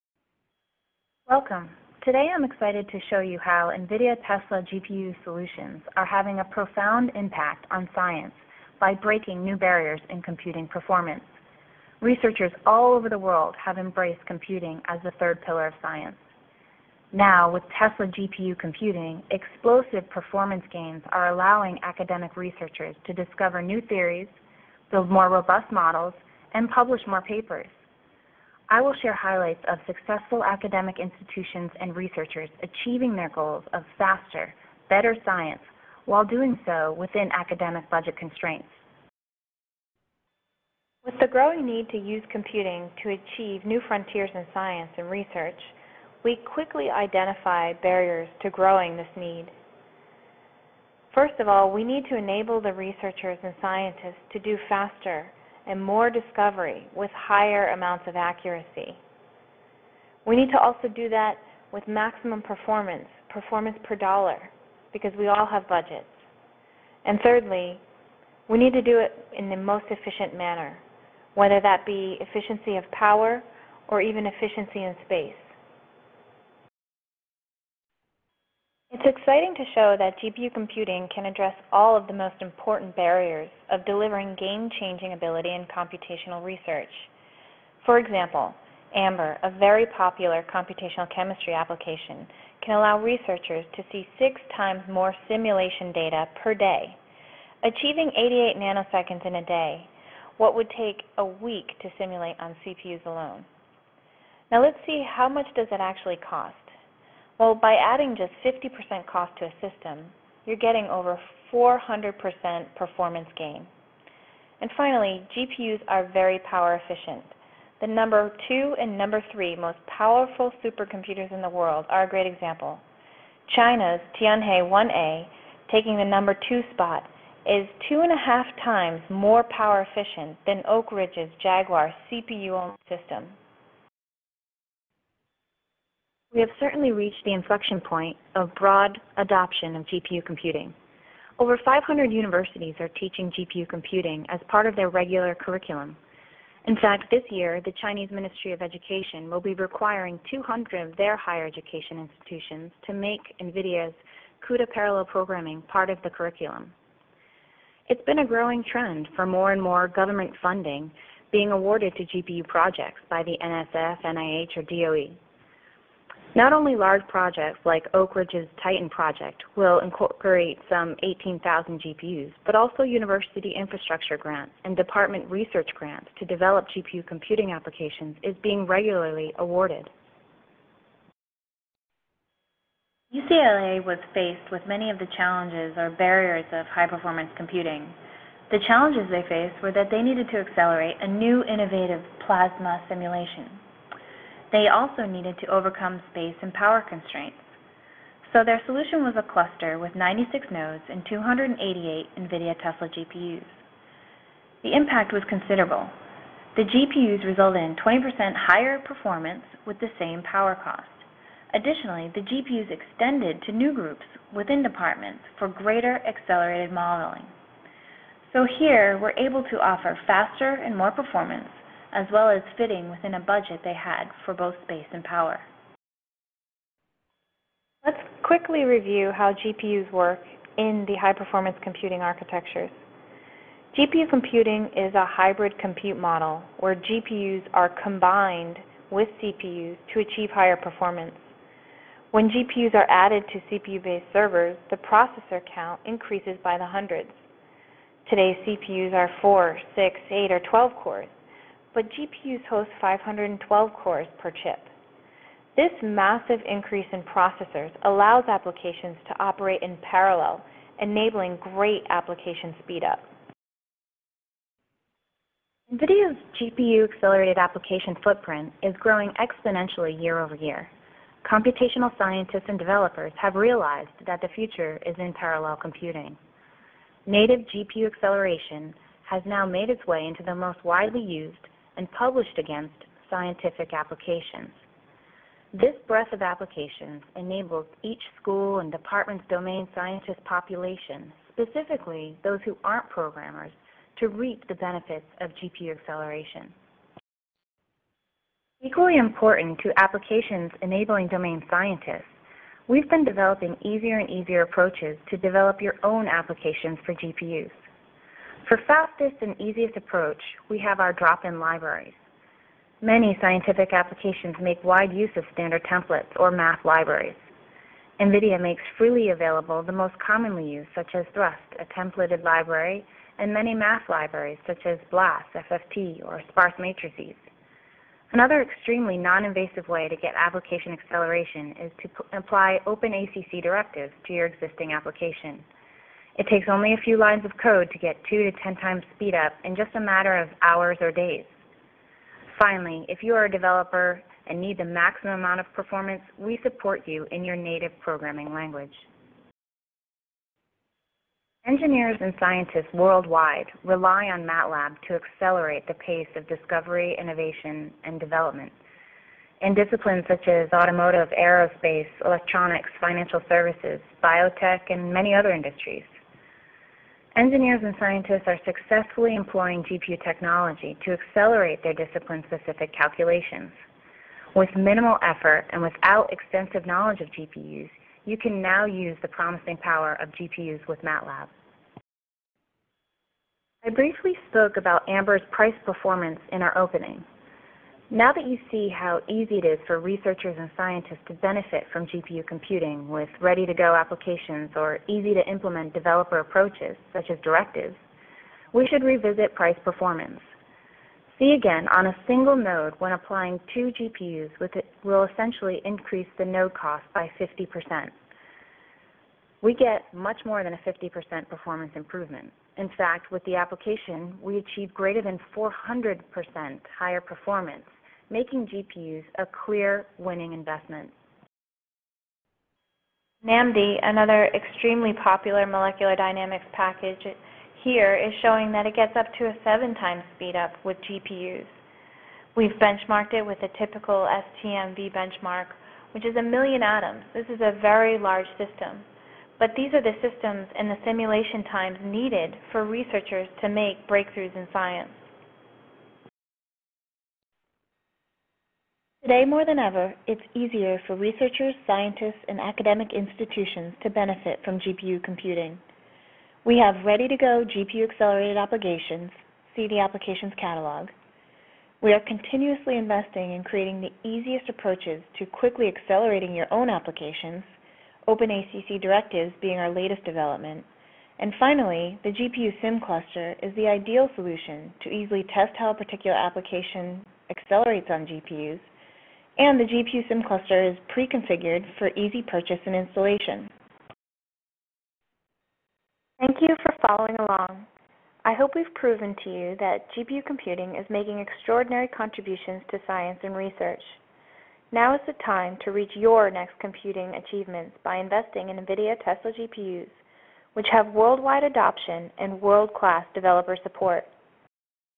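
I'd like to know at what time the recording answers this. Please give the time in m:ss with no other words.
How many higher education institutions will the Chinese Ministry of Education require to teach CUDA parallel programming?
2:30.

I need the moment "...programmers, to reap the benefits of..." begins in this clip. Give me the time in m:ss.
4:52.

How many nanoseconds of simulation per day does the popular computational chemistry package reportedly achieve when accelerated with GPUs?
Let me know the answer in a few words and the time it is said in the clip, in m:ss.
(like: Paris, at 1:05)
88, at 1:38.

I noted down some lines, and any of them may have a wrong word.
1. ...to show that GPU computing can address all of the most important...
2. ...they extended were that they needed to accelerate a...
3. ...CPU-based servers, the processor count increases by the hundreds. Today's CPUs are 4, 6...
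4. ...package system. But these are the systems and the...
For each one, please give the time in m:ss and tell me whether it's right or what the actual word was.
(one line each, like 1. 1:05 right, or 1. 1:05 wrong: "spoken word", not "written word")
1. 1:19 right
2. 3:09 wrong: "faced", not "extended"
3. 4:03 right
4. 7:17 wrong: "large", not "package".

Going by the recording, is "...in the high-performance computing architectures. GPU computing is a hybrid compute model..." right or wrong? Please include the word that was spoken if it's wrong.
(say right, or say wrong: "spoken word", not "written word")
right.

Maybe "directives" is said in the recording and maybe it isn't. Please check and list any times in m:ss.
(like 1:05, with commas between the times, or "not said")
5:33, 6:37, 7:48.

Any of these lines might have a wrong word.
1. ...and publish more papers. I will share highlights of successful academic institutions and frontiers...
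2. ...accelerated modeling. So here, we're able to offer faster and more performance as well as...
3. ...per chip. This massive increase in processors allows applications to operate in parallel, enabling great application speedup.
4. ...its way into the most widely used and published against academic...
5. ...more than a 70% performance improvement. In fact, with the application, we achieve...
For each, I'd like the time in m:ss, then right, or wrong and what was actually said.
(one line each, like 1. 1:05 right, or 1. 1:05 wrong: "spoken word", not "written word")
1. 0:26 wrong: "researchers", not "frontiers"
2. 3:36 right
3. 4:14 right
4. 4:39 wrong: "scientific", not "academic"
5. 6:50 wrong: "50", not "70".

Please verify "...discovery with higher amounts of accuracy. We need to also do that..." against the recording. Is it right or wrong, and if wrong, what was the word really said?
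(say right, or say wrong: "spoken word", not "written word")
right.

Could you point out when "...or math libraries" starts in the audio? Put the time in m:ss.
5:16.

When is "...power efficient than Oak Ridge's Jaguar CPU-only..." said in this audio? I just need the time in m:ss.
2:09.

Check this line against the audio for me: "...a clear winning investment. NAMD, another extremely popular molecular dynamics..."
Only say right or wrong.
right.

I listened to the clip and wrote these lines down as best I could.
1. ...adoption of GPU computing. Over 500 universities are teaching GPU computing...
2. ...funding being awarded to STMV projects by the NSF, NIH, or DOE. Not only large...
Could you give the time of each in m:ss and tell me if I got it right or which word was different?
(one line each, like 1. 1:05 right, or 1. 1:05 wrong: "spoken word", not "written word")
1. 2:19 right
2. 2:40 wrong: "GPU", not "STMV".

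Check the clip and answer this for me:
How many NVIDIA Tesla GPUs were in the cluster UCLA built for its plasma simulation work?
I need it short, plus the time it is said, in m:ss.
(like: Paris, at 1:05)
288, at 3:21.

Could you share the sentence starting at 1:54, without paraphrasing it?
And finally, GPUs are very power efficient.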